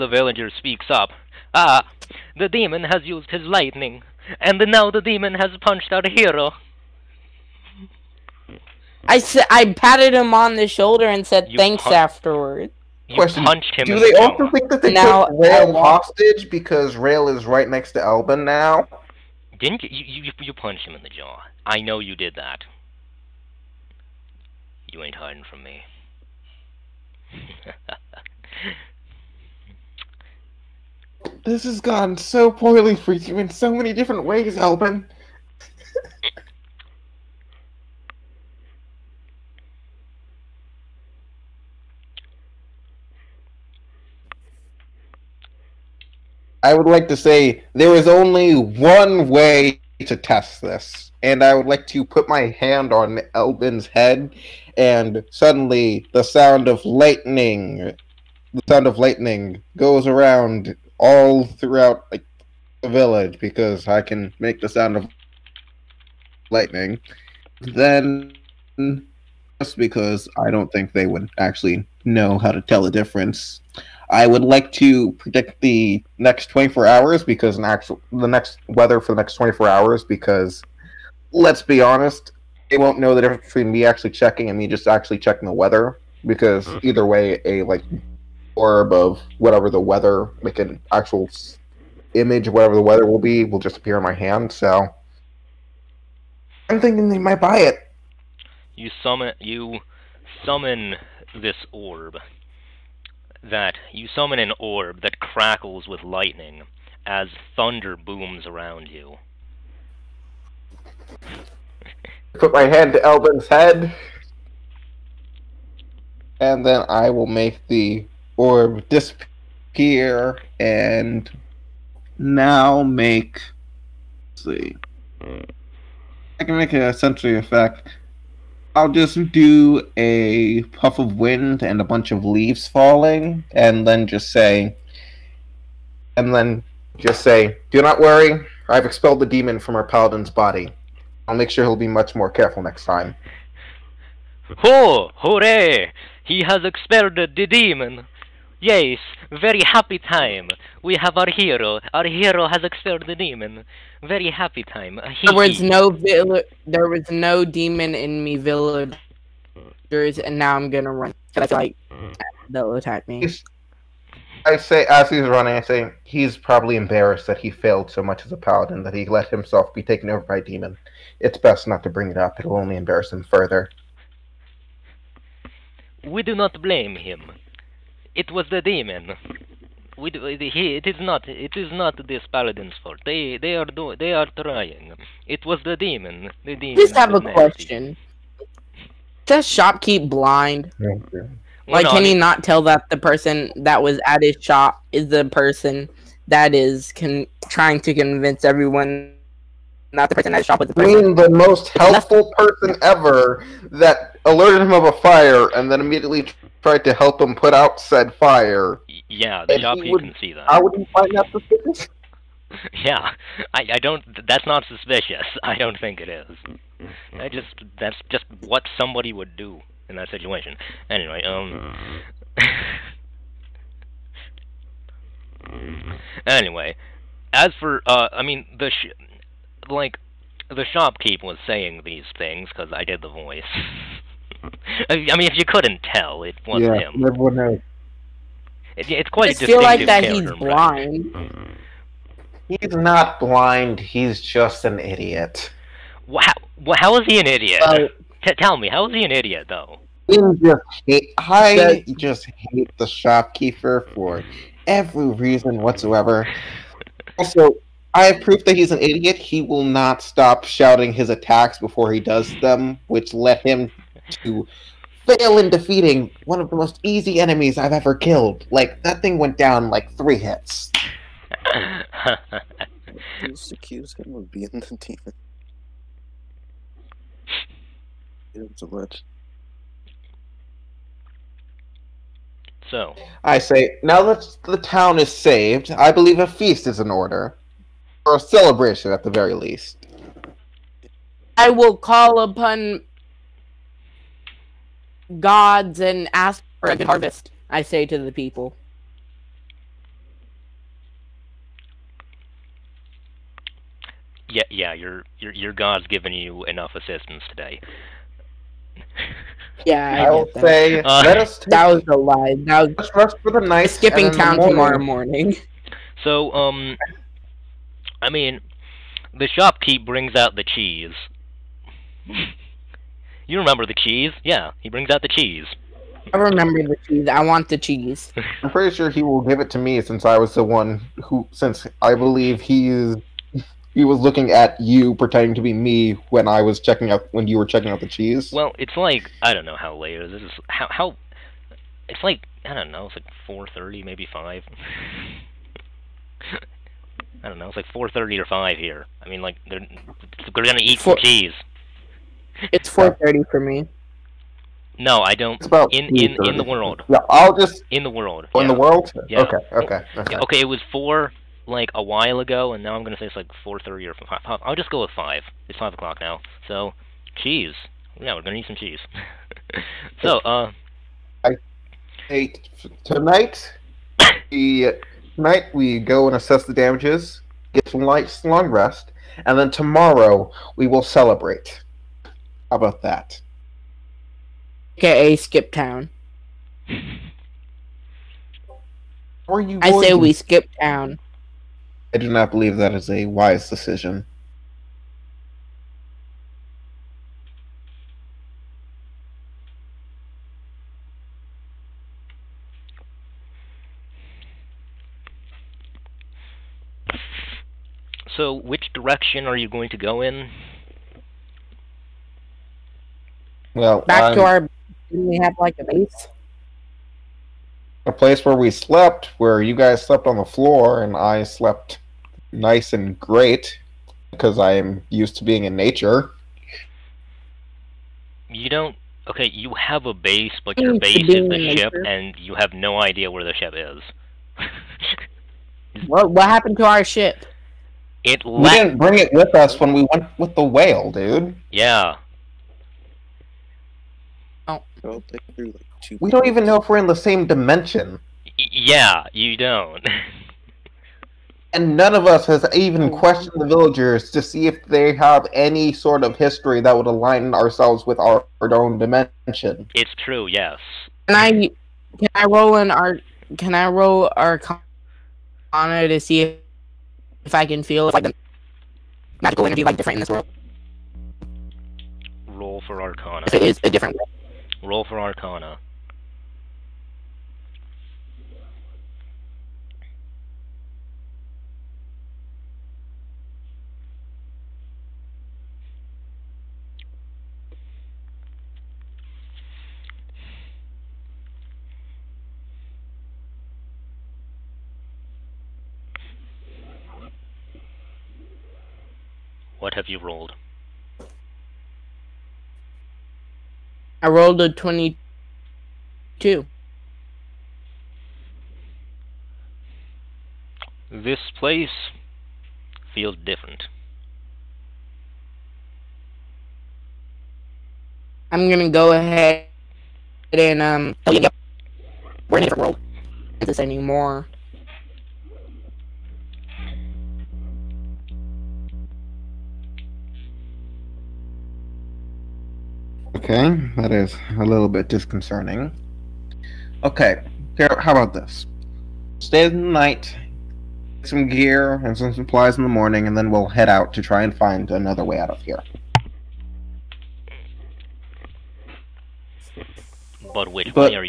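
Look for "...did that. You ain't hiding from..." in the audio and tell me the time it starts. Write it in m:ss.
0:22.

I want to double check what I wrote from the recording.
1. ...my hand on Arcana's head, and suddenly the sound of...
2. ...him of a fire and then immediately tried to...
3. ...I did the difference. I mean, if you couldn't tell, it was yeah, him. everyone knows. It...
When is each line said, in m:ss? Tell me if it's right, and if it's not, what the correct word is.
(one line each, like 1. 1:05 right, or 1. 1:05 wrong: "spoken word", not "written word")
1. 0:52 wrong: "Elvin", not "Arcana"
2. 3:24 right
3. 3:52 wrong: "voice", not "difference".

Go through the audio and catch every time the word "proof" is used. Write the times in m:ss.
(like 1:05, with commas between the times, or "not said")
4:18.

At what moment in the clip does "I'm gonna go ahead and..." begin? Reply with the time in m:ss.
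8:38.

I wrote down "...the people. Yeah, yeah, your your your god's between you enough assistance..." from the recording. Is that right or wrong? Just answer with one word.
wrong.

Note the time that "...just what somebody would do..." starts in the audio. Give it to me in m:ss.
3:38.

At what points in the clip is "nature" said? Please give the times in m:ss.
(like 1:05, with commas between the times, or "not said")
7:05, 7:11.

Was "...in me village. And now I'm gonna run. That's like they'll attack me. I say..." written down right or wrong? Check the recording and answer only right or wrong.
right.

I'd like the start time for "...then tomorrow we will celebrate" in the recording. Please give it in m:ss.
6:19.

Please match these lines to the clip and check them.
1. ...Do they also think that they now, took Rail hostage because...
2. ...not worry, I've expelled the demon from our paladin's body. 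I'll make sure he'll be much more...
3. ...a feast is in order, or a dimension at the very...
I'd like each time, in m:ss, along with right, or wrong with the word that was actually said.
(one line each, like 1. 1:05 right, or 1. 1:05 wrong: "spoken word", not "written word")
1. 0:13 right
2. 2:17 right
3. 4:46 wrong: "celebration", not "dimension".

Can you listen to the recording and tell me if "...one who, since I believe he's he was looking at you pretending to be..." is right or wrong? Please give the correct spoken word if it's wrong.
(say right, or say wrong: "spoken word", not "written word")
right.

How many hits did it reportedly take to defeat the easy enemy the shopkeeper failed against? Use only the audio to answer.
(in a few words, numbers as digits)
Three.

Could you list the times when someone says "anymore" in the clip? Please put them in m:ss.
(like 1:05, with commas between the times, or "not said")
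8:43.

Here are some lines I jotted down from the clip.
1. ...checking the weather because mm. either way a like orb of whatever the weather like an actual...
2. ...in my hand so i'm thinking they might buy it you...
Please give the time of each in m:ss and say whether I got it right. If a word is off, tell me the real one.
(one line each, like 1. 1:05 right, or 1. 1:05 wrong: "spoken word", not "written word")
1. 1:25 right
2. 1:33 right.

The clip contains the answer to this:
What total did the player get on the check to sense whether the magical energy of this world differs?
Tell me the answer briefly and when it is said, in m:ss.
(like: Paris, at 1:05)
22, at 8:24.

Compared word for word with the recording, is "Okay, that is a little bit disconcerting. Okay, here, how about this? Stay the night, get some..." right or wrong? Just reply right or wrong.
right.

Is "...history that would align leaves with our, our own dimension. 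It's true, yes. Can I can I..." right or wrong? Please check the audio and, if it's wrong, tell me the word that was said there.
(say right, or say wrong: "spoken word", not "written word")
wrong: "ourselves", not "leaves".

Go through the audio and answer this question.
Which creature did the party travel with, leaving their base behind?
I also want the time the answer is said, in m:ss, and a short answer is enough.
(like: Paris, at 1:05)
The whale, at 7:19.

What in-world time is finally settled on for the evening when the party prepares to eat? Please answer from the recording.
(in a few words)
5 o'clock.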